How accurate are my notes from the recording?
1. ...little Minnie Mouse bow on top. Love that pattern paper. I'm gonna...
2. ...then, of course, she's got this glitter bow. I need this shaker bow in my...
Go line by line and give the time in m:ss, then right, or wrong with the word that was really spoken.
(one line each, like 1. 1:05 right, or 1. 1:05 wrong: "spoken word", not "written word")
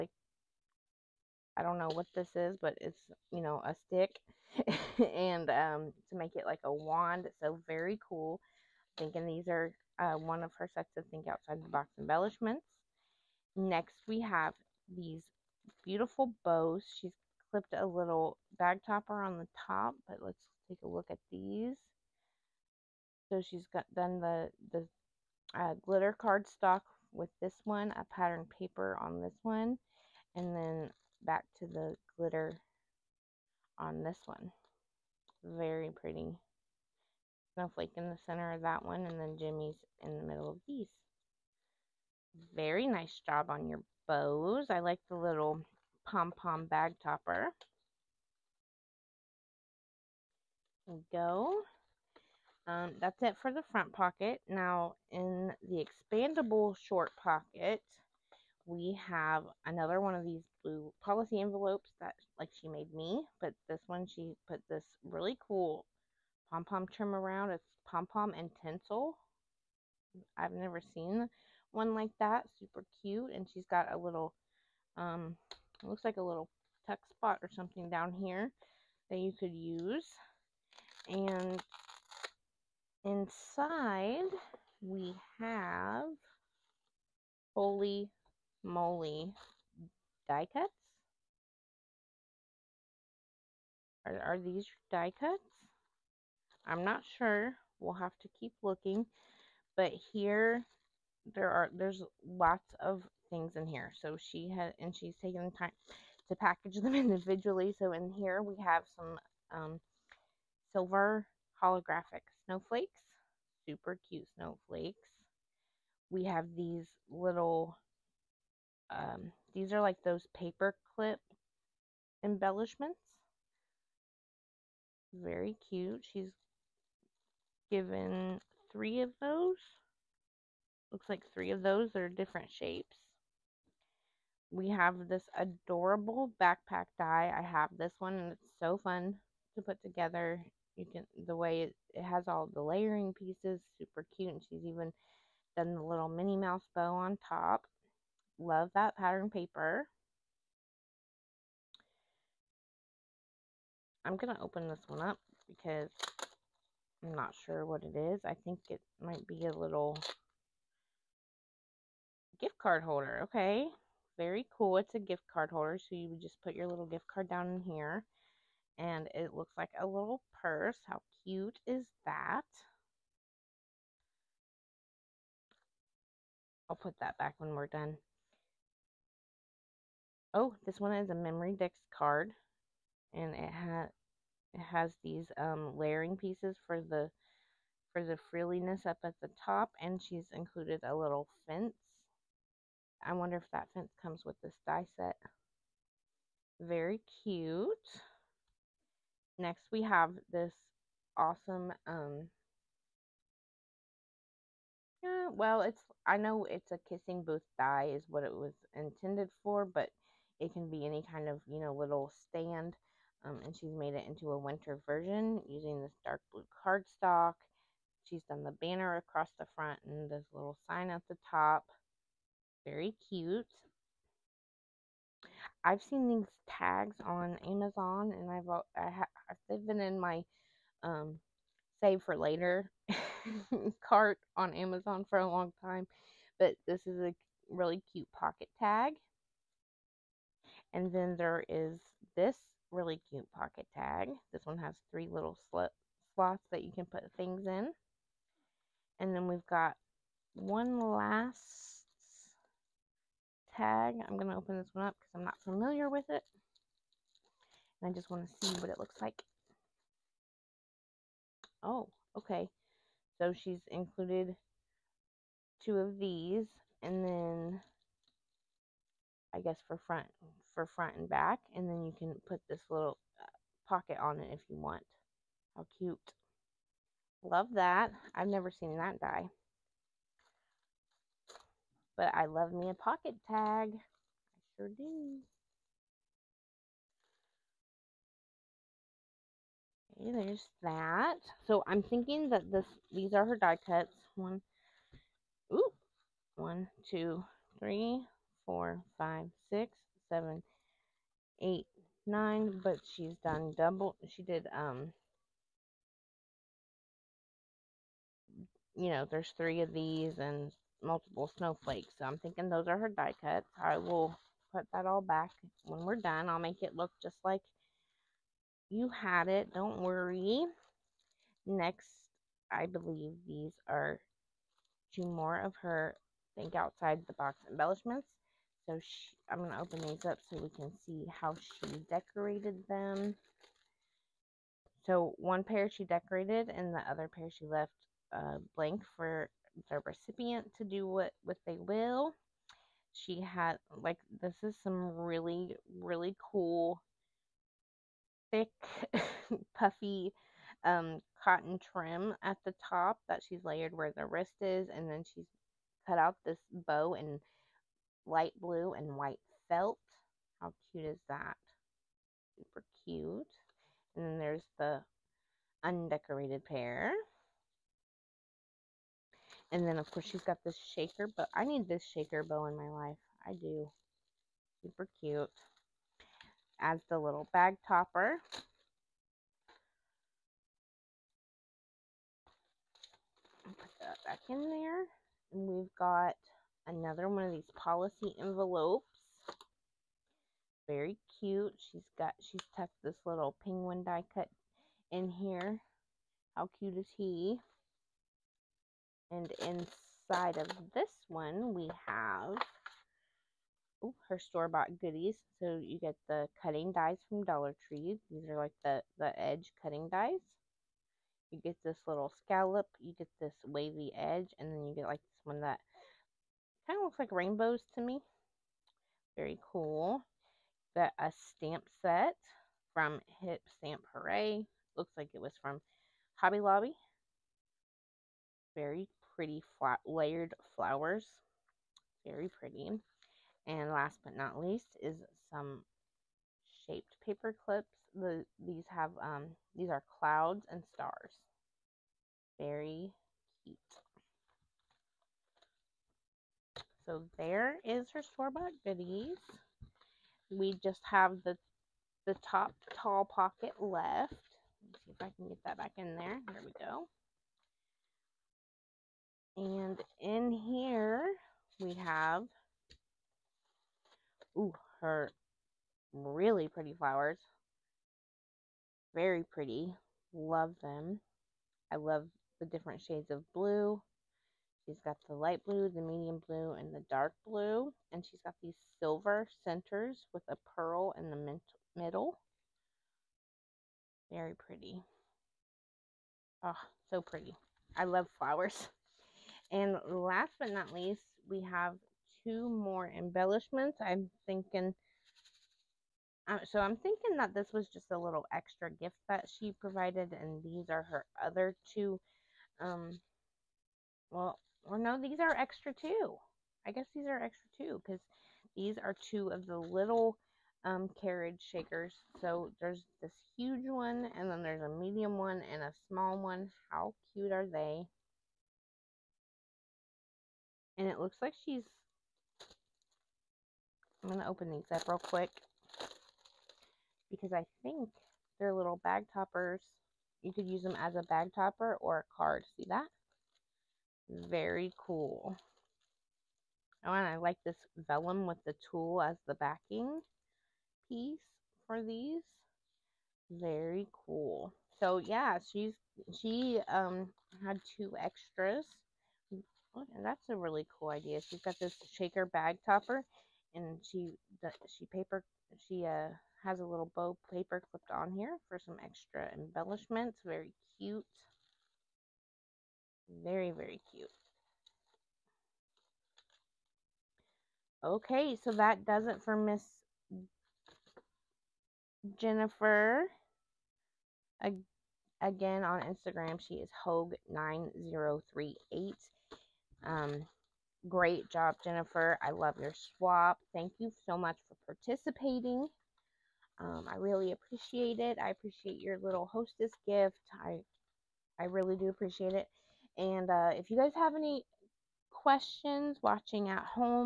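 1. 2:25 right
2. 6:09 wrong: "shaker", not "glitter".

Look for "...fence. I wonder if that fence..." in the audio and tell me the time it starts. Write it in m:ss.
3:11.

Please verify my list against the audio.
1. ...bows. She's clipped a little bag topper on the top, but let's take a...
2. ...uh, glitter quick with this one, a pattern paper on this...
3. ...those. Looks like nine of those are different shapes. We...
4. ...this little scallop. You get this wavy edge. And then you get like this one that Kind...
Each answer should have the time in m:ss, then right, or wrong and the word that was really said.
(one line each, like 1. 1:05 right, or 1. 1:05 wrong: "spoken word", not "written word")
1. 0:16 right
2. 0:25 wrong: "cardstock", not "quick"
3. 2:09 wrong: "three", not "nine"
4. 6:51 right.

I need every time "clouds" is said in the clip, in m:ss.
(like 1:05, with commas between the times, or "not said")
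7:20.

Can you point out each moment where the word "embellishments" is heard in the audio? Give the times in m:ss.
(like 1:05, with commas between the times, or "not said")
0:11, 2:02, 5:27, 8:12, 9:19.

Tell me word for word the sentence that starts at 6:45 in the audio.
So you get the cutting dies from Dollar Tree.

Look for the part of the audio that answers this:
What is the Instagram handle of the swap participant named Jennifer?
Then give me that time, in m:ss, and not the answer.
9:36.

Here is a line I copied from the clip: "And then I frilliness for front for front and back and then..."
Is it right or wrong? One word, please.
wrong.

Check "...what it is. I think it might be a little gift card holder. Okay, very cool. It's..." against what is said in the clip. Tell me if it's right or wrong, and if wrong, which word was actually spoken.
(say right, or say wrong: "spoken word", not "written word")
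right.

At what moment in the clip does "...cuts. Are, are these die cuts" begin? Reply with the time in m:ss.
1:30.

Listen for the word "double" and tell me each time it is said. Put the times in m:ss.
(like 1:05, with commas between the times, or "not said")
5:03.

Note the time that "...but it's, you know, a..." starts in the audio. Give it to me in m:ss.
0:02.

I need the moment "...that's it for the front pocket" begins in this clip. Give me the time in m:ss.
0:53.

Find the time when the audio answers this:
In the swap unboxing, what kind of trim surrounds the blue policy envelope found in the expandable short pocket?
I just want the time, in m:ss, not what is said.
1:07.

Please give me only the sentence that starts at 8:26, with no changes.
I guess these are extra two because these are two of the little um, carriage shakers.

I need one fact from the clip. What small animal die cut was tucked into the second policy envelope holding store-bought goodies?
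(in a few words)
penguin.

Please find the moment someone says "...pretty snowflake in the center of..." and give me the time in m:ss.
0:35.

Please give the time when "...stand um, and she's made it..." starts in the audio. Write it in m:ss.
3:32.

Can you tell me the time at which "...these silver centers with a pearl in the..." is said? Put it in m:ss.
7:58.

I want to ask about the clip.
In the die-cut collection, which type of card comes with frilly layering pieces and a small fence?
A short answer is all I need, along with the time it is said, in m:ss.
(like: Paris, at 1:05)
memory dex card, at 3:01.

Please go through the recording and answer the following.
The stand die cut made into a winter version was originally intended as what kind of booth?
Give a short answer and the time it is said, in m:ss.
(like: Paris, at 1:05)
kissing booth, at 3:26.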